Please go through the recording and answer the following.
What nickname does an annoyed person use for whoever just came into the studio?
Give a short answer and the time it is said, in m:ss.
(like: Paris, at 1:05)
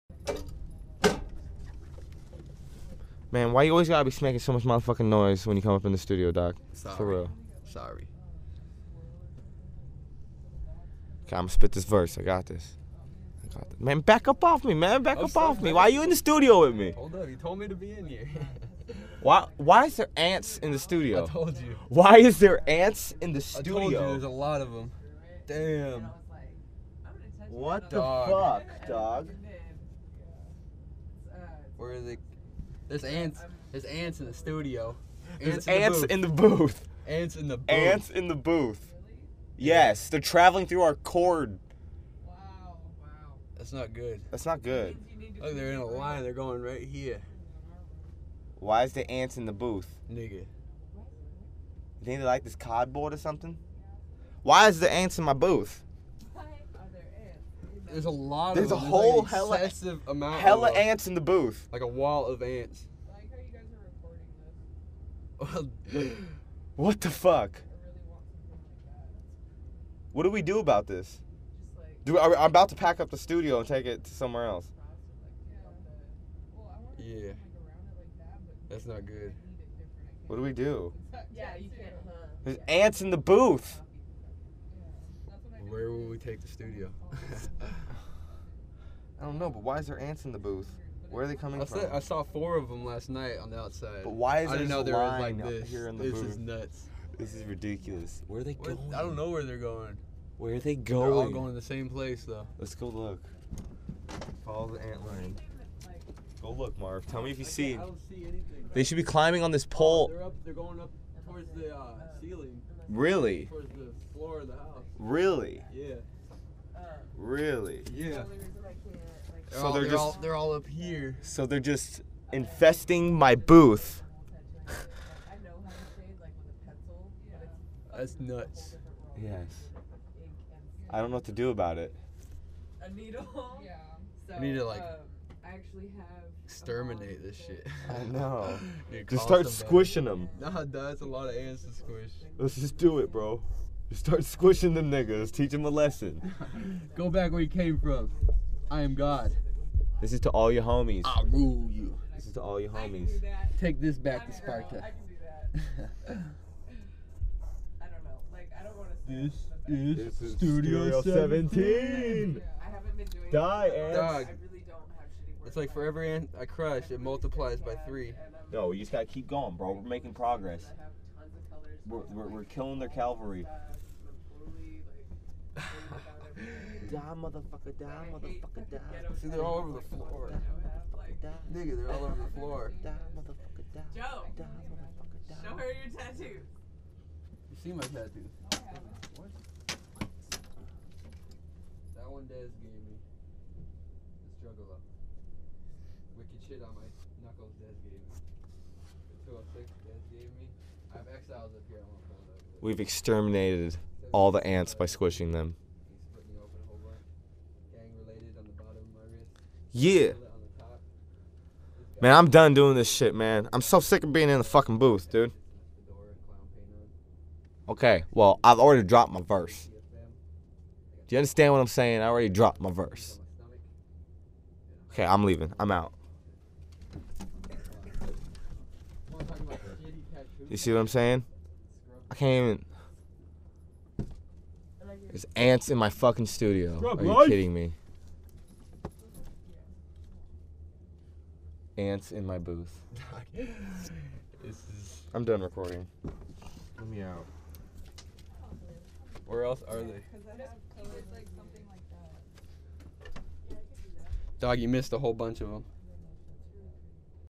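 doc, at 0:06.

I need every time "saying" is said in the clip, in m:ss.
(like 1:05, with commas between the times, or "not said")
3:41, 3:50.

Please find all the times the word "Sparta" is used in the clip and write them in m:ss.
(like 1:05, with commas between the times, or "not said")
2:34.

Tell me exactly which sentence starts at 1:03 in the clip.
I like how you guys are recording this.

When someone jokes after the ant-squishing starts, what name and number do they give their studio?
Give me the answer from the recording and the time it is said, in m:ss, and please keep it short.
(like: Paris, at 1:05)
Studio 17, at 2:40.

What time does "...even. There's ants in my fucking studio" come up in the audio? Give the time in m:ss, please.
3:53.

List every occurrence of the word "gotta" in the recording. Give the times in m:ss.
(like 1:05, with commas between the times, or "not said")
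0:03, 2:48.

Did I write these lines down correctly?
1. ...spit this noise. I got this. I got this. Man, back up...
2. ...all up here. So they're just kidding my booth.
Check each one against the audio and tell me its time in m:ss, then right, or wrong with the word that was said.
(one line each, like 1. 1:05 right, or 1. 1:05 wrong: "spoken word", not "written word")
1. 0:11 wrong: "verse", not "noise"
2. 2:00 wrong: "infesting", not "kidding".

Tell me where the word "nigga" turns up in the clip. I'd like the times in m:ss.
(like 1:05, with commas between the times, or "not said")
0:50, 2:24, 3:01.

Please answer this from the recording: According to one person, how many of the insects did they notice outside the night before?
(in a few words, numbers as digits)
4.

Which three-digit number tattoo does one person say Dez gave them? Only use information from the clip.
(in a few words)
206.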